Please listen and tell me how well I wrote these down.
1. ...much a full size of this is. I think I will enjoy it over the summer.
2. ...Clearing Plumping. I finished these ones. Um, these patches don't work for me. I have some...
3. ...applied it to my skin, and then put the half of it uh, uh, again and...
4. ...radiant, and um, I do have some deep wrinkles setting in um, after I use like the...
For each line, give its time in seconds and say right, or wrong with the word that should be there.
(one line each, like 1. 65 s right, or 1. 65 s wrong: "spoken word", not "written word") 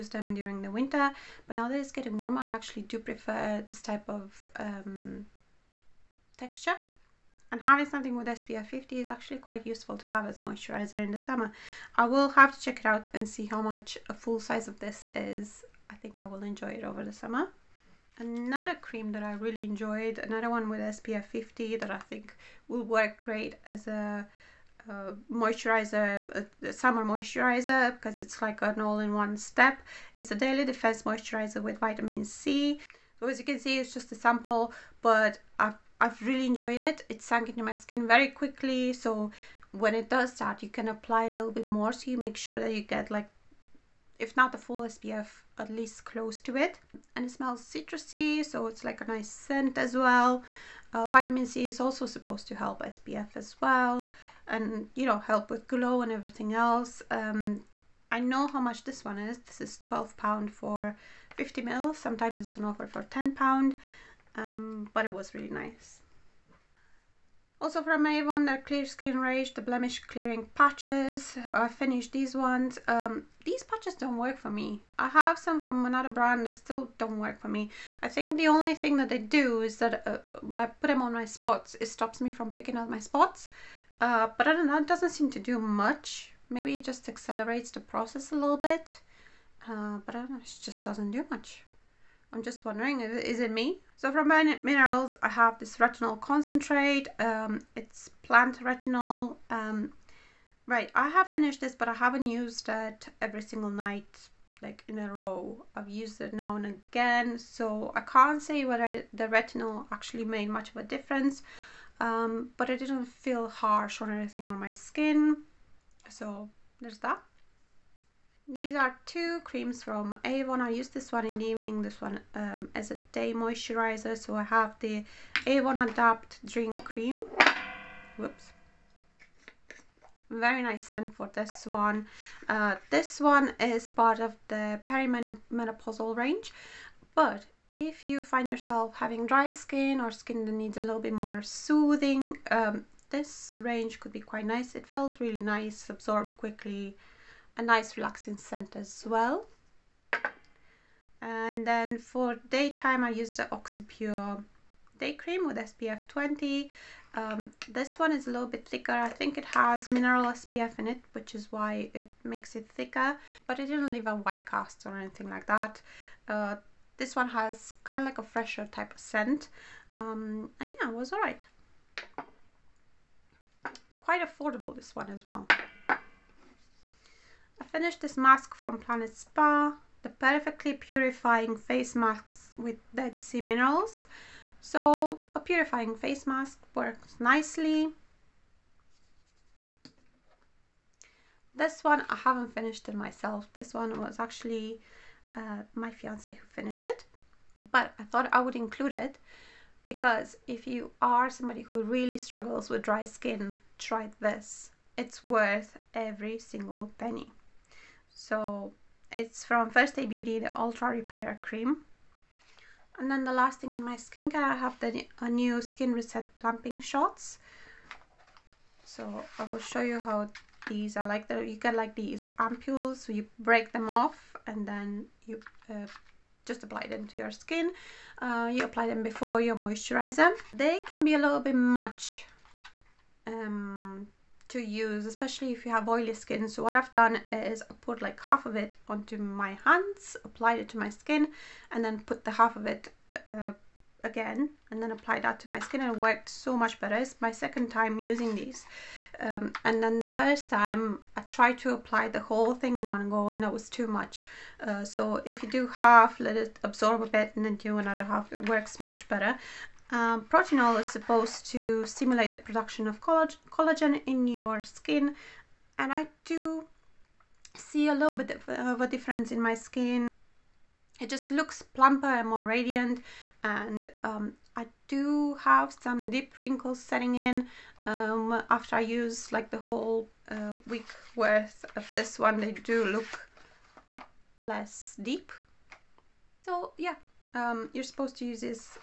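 1. 13 s right
2. 70 s wrong: "Patches", not "Plumping"
3. 240 s right
4. 272 s right.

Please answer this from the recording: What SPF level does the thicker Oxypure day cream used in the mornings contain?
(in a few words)
SPF 20.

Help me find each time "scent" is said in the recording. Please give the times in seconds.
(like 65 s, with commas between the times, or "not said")
49 s, 130 s, 148 s, 168 s.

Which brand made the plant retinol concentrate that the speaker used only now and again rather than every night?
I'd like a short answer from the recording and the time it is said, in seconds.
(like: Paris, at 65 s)
min minerals, at 94 s.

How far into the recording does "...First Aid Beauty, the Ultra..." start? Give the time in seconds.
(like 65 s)
209 s.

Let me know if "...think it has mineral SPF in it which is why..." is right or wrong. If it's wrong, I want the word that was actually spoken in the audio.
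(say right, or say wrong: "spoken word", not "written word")
right.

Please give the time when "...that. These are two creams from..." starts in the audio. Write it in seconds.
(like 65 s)
116 s.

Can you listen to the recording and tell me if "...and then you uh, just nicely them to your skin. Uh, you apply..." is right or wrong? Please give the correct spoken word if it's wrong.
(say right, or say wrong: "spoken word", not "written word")
wrong: "apply", not "nicely".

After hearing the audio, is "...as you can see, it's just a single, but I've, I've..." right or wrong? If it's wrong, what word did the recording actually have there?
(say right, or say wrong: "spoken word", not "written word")
wrong: "sample", not "single".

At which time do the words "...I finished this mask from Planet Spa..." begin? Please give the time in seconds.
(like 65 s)
177 s.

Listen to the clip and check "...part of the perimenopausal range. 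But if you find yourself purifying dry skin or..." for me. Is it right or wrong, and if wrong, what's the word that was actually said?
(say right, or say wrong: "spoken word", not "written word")
wrong: "having", not "purifying".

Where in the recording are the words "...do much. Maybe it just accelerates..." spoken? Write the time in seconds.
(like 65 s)
85 s.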